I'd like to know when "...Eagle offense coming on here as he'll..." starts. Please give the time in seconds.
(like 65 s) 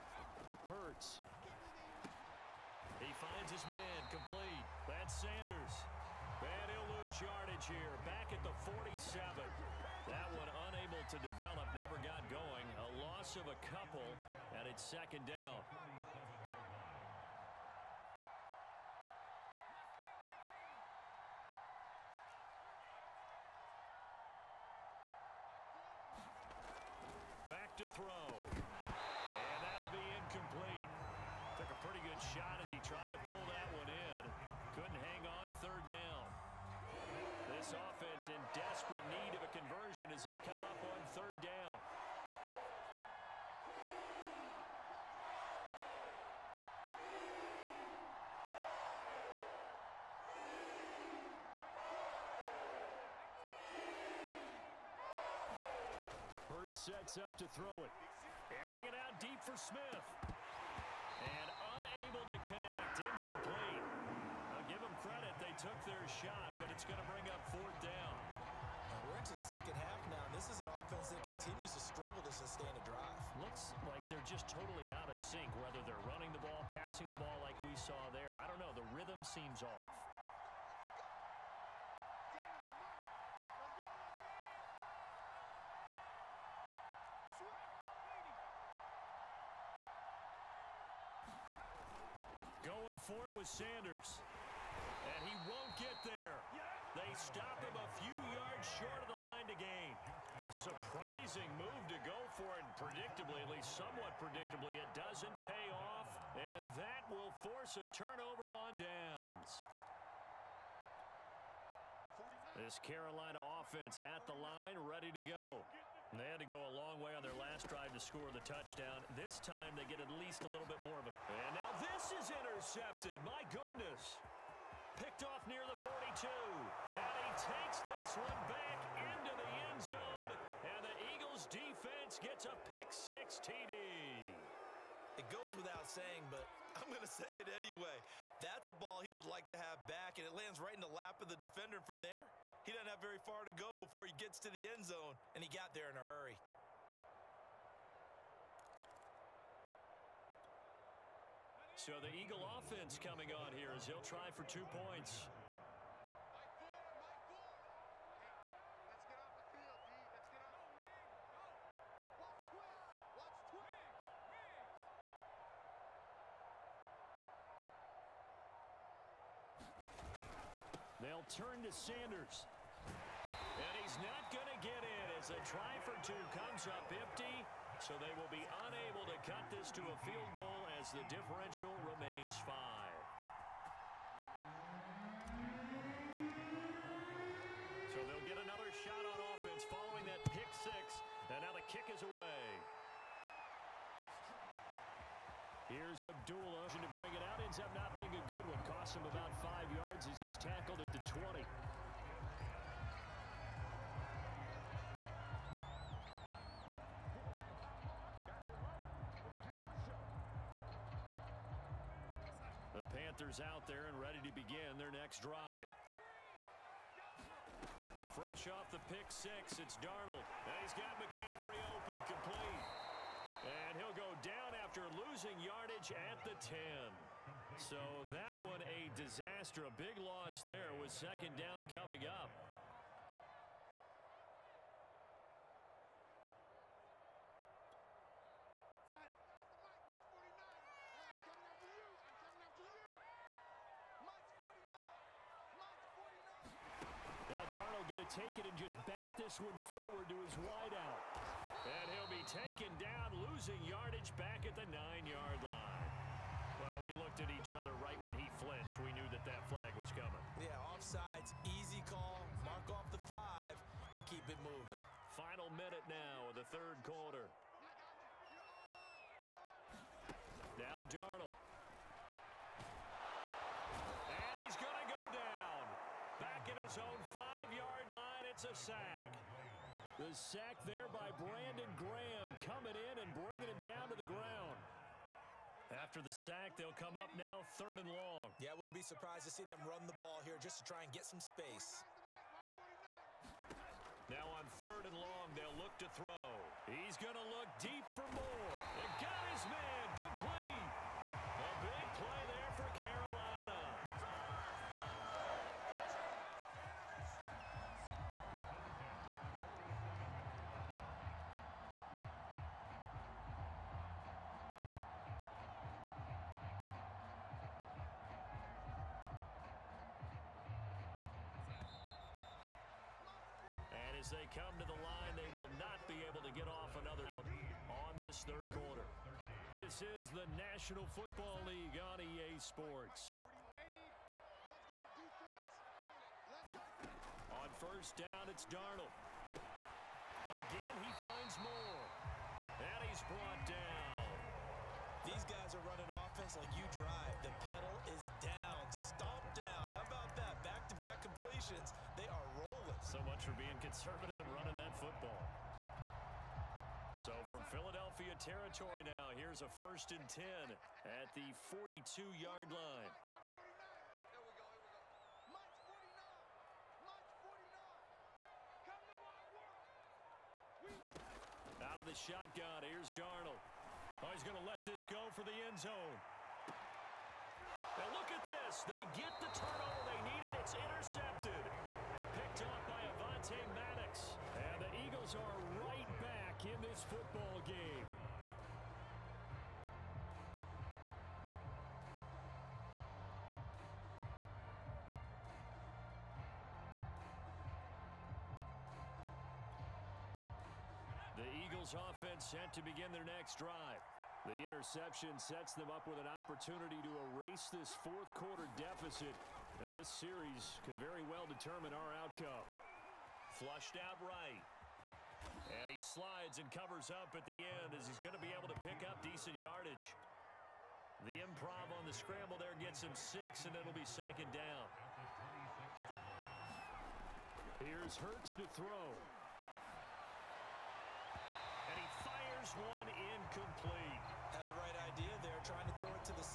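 152 s.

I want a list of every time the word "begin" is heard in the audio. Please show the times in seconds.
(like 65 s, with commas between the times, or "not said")
402 s.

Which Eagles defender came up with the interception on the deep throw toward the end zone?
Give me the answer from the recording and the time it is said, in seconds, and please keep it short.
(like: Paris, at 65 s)
Avonte Maddox, at 382 s.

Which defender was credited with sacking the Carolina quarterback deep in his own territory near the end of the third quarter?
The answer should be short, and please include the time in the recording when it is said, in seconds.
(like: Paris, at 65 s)
Brandon Graham, at 281 s.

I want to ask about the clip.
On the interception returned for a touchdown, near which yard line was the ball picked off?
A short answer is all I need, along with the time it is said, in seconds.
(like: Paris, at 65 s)
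42, at 125 s.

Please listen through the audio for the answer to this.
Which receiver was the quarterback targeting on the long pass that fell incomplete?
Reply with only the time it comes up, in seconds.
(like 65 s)
59 s.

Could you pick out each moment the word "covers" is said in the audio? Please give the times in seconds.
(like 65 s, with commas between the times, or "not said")
416 s.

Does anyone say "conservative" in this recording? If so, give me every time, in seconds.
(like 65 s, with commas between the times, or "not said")
353 s.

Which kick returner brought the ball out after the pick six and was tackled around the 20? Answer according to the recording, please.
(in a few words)
Abdullah.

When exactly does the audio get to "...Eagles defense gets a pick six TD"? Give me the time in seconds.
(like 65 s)
131 s.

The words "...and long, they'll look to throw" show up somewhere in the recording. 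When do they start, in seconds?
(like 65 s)
294 s.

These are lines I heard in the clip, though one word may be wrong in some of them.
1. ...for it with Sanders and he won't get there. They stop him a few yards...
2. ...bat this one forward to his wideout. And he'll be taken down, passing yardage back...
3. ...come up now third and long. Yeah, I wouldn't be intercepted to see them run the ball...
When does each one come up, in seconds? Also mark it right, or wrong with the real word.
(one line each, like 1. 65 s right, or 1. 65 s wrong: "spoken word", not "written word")
1. 93 s right
2. 248 s wrong: "losing", not "passing"
3. 286 s wrong: "surprised", not "intercepted".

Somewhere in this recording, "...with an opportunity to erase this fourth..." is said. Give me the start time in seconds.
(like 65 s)
405 s.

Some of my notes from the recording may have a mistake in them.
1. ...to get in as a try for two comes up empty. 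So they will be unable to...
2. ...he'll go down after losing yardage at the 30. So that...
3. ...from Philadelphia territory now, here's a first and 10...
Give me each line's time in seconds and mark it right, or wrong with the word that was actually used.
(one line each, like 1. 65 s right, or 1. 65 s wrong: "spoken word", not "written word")
1. 174 s right
2. 223 s wrong: "10", not "30"
3. 357 s right.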